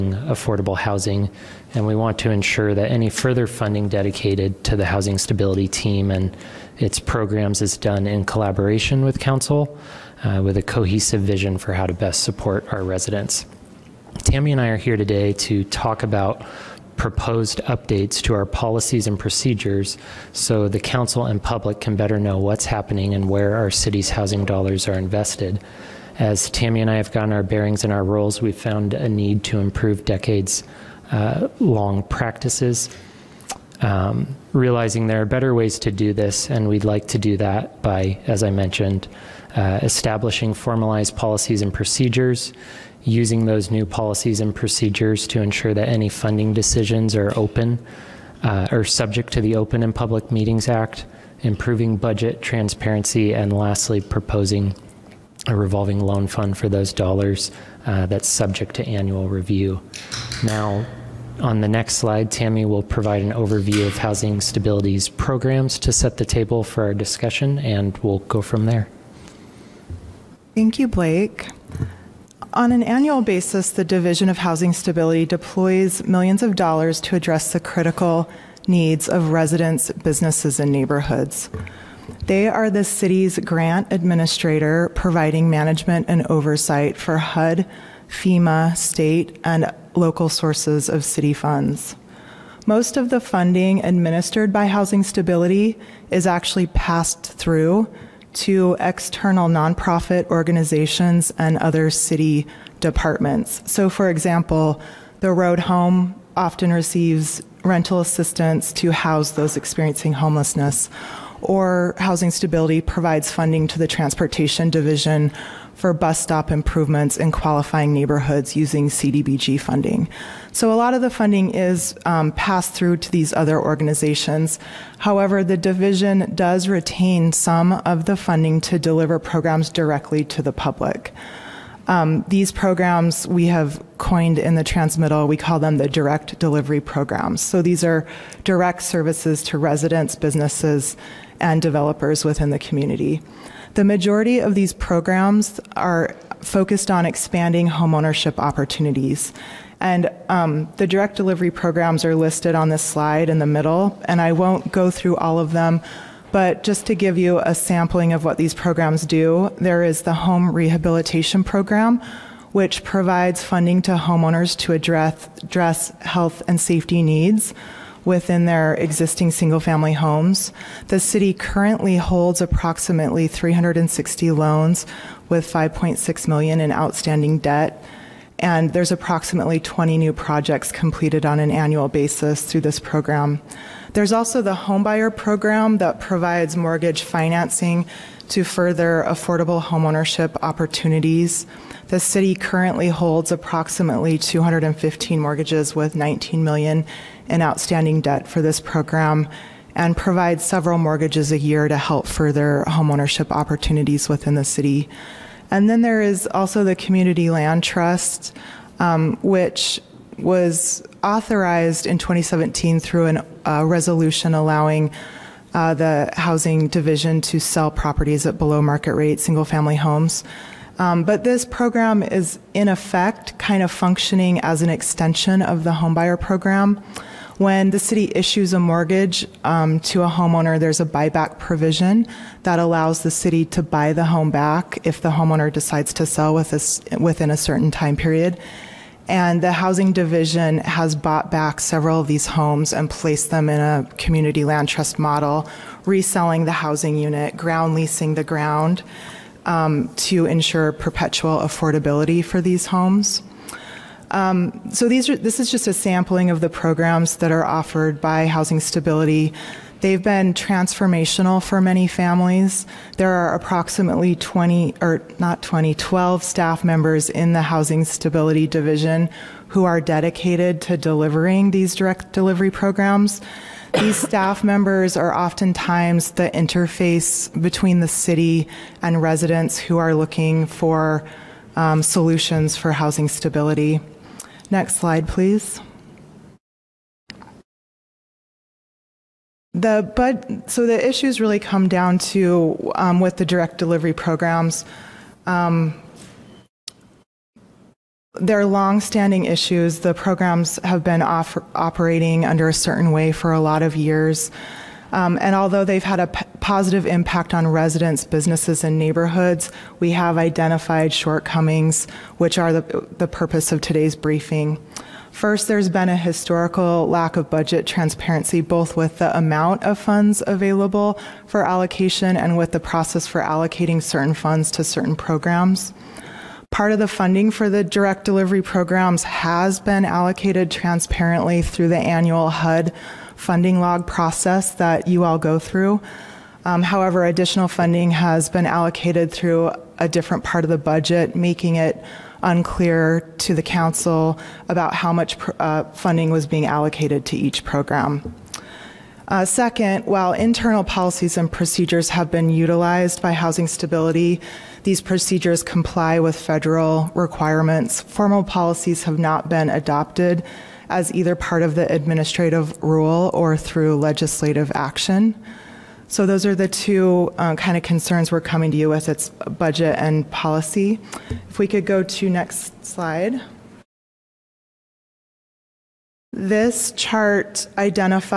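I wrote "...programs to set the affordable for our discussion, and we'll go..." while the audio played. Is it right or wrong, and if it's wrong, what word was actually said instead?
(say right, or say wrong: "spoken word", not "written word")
wrong: "table", not "affordable".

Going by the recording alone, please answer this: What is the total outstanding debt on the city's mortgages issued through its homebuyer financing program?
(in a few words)
$19 million.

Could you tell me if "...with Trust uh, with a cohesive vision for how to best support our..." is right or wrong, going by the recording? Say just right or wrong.
wrong.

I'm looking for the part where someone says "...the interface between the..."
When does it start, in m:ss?
4:36.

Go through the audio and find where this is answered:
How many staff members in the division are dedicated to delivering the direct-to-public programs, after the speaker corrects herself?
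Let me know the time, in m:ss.
4:25.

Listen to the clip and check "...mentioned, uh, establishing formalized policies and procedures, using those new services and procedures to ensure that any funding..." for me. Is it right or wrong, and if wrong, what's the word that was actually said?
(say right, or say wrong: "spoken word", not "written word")
wrong: "policies", not "services".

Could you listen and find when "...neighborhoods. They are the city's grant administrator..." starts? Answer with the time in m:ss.
1:20.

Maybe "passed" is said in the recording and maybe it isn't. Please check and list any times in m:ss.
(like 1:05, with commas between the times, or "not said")
1:36, 2:02.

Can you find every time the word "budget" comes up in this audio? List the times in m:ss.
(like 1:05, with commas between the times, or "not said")
0:51, 5:17, 5:40, 6:09.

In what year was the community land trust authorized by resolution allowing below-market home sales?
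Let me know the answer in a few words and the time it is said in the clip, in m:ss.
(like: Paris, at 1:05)
2017, at 3:31.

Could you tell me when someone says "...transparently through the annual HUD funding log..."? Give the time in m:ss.
5:30.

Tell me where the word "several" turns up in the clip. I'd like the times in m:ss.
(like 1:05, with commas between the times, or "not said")
3:20, 4:01.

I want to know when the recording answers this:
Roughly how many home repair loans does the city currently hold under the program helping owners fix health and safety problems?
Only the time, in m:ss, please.
2:53.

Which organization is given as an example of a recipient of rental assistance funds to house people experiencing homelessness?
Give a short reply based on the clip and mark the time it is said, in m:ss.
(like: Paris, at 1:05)
The Road Home, at 1:45.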